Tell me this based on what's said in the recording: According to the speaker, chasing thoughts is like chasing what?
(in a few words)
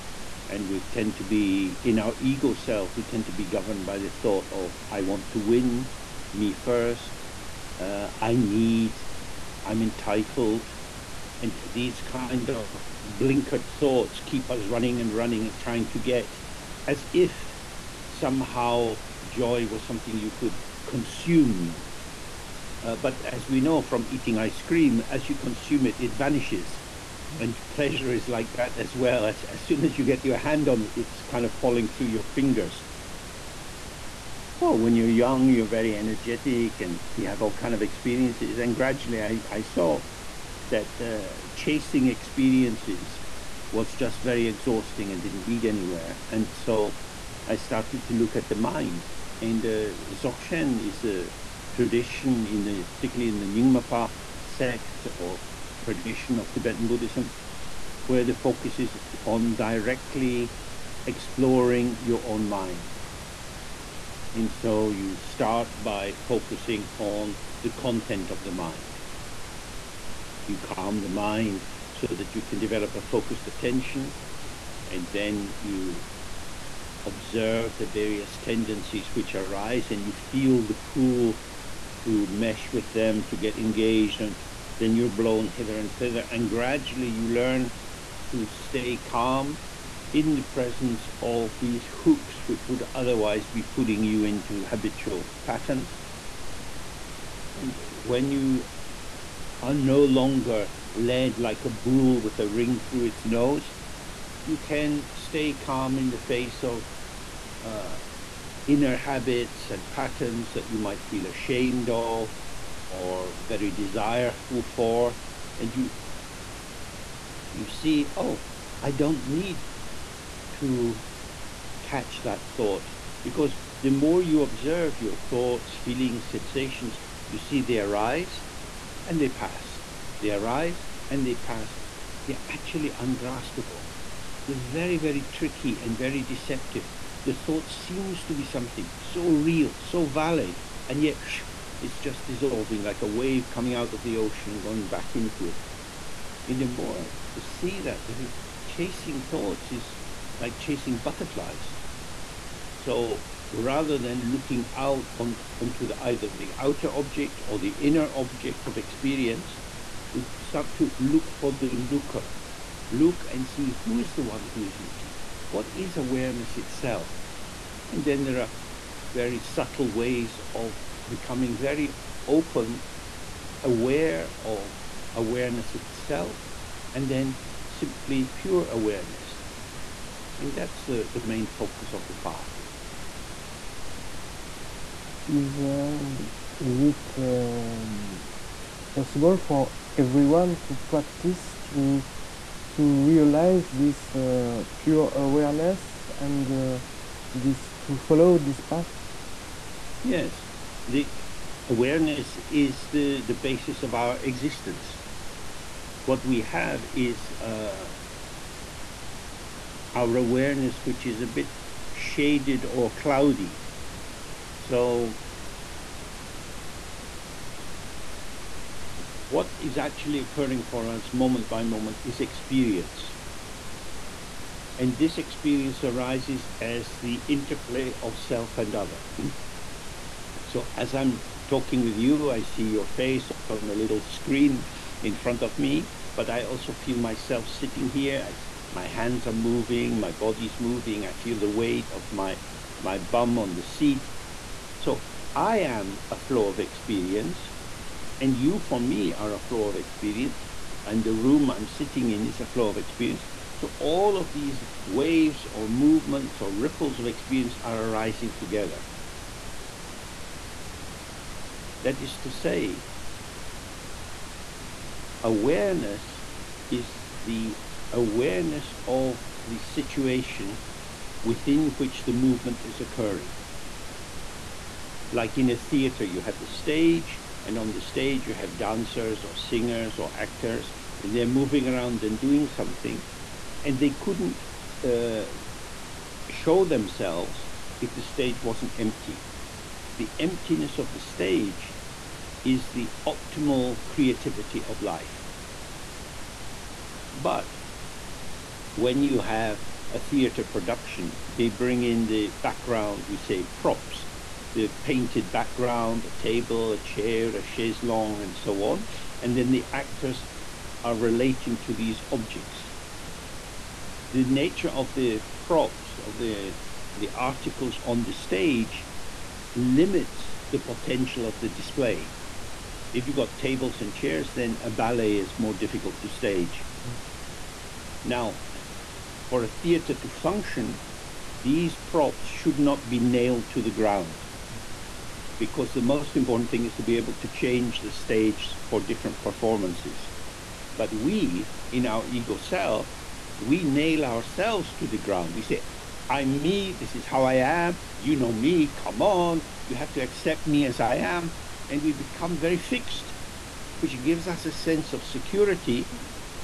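Butterflies.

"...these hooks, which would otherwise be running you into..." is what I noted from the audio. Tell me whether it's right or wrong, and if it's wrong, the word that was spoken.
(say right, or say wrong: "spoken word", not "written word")
wrong: "putting", not "running".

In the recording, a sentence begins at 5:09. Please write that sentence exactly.
And then the actors are relating to these objects.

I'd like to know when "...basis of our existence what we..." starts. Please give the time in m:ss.
3:23.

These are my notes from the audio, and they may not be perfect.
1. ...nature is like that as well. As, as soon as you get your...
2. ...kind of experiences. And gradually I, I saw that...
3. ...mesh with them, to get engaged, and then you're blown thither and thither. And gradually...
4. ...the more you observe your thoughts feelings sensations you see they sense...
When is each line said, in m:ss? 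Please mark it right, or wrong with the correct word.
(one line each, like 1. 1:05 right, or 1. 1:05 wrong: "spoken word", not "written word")
1. 0:27 wrong: "pleasure", not "nature"
2. 0:37 right
3. 1:22 wrong: "hither", not "thither"
4. 2:03 wrong: "arise", not "sense".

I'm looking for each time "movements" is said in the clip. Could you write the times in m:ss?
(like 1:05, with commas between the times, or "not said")
4:15, 4:32.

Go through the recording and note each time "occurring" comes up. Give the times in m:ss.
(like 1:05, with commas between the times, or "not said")
3:40, 4:32.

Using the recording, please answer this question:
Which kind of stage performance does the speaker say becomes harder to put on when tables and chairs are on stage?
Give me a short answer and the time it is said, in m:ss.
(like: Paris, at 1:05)
A ballet, at 5:24.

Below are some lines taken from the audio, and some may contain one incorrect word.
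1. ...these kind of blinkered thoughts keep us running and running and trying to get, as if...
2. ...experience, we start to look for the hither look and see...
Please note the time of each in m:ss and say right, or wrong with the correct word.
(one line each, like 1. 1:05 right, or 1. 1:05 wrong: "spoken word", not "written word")
1. 0:11 right
2. 2:38 wrong: "looker", not "hither".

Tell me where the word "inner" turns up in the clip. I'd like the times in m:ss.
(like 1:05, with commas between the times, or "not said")
1:48, 2:37.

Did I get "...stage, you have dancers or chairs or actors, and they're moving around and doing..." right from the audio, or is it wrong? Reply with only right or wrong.
wrong.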